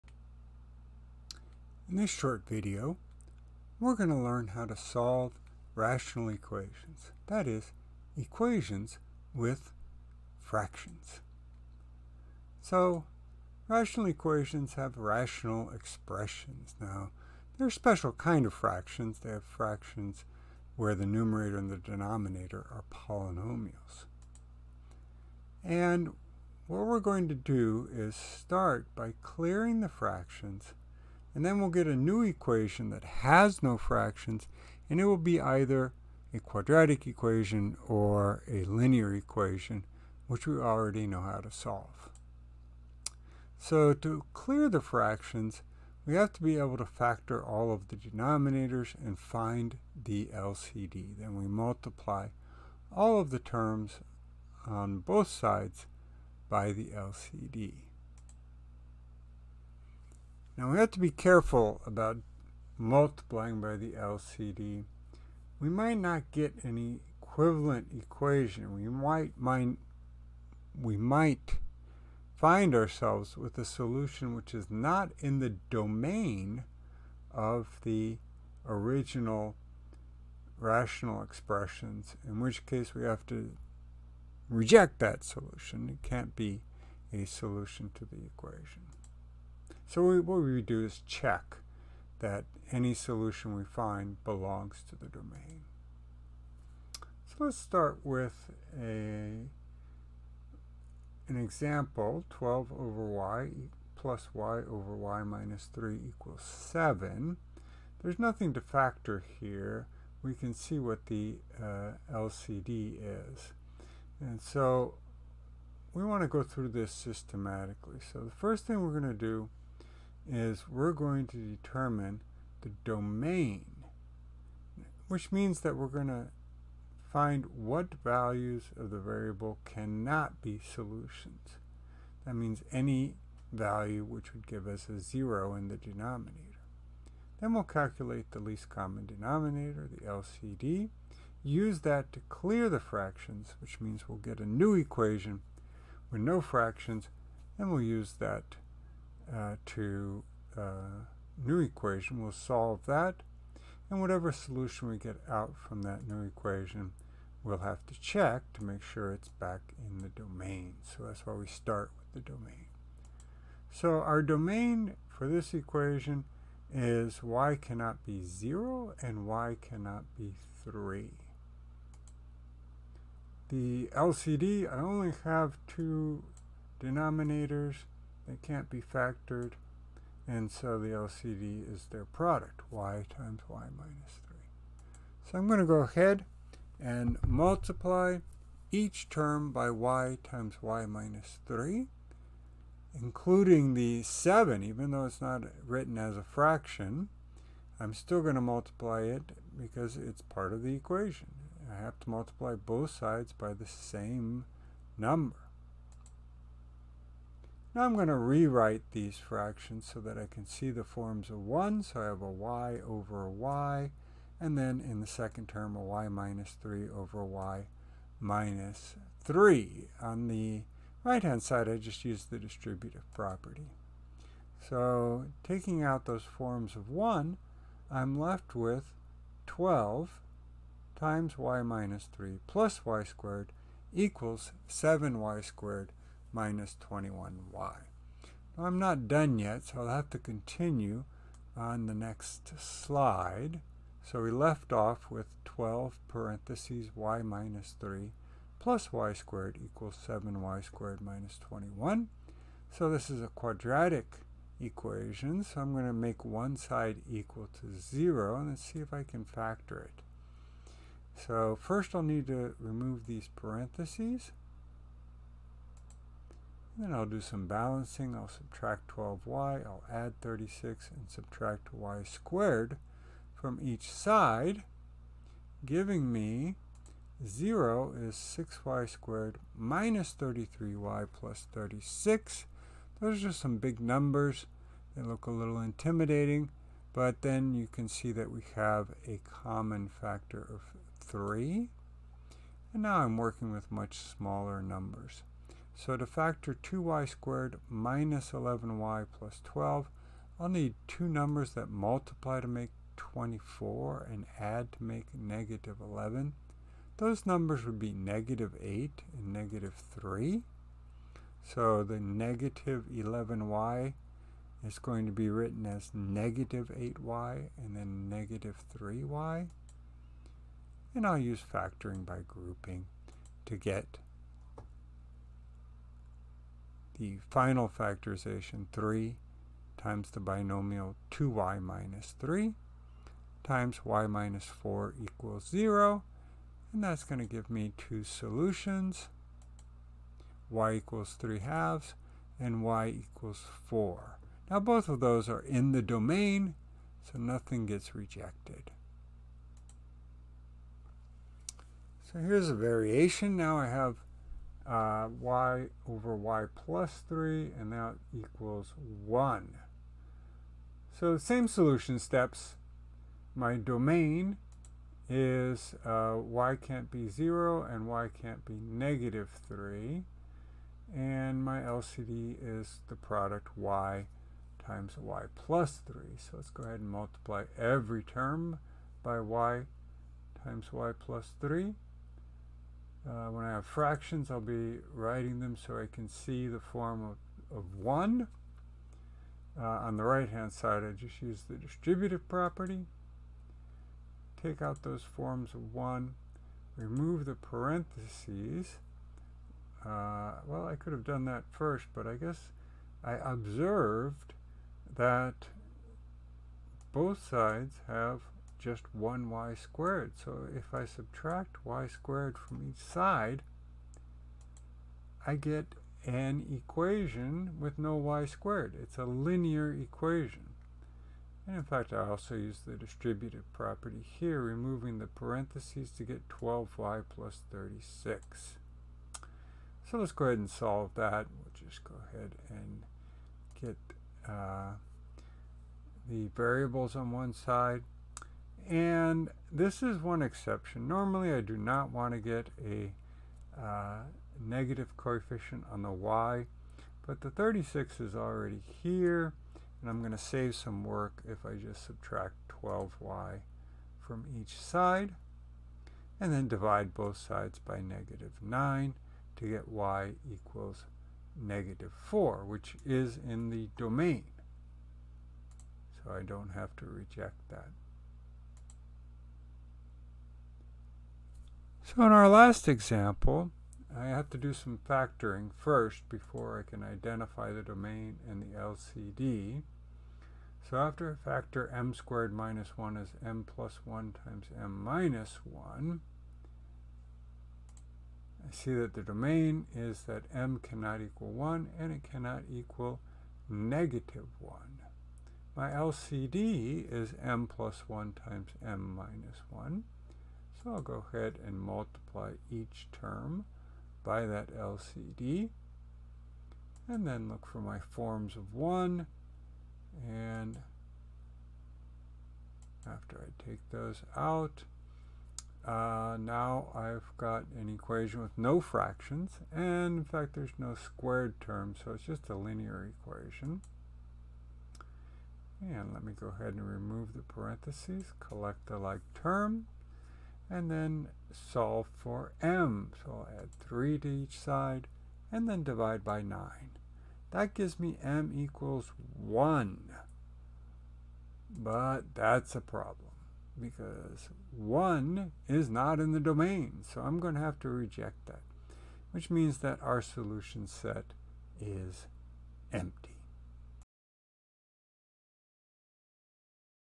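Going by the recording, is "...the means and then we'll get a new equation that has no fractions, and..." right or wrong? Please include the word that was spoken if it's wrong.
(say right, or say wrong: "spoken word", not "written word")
wrong: "fractions", not "means".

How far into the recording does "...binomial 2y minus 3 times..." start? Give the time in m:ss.
5:30.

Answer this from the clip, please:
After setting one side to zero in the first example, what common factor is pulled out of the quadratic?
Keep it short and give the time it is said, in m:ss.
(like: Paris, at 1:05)
3, at 4:49.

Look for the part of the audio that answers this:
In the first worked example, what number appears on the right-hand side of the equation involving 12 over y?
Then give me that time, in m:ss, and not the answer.
1:46.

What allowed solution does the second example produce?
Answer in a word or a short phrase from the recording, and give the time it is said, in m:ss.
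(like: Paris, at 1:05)
y = -4, at 7:39.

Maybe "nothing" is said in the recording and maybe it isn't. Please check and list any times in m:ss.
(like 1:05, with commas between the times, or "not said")
1:48, 5:47.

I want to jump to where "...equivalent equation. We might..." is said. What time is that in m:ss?
1:07.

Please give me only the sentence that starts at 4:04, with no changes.
So we left off with 12 parentheses y minus 3 plus y squared equals 7y squared minus 21.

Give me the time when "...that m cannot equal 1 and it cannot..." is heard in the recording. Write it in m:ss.
8:10.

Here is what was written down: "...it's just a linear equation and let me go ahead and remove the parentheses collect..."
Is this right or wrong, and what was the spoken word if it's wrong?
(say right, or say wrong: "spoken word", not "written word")
right.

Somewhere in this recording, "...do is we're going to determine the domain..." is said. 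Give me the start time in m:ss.
1:59.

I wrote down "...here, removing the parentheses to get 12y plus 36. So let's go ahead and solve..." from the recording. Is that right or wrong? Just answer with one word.
right.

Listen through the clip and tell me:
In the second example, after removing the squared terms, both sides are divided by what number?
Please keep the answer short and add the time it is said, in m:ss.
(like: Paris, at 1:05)
-9, at 7:37.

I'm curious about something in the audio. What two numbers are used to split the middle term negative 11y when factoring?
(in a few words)
-8 and -3.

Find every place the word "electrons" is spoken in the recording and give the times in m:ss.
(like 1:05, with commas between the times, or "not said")
not said.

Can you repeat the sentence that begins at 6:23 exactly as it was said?
Uh, when I have fractions, I'll be writing them so I can see the form of, of 1.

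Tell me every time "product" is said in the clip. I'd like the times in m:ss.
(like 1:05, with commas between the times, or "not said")
3:02, 6:12.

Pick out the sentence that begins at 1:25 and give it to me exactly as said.
It can't be a solution to the equation.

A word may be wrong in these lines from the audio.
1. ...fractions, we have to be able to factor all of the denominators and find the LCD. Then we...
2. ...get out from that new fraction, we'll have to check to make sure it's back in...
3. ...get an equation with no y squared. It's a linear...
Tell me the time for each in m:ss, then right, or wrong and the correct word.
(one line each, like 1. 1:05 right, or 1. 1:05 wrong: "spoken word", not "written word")
1. 0:44 right
2. 2:34 wrong: "equation", not "fraction"
3. 6:55 right.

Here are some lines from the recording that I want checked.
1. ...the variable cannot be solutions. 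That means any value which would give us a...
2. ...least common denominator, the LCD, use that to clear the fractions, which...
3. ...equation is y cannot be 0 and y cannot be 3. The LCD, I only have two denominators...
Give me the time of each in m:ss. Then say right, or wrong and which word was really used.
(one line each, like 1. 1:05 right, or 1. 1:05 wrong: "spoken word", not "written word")
1. 2:08 right
2. 2:18 right
3. 2:45 right.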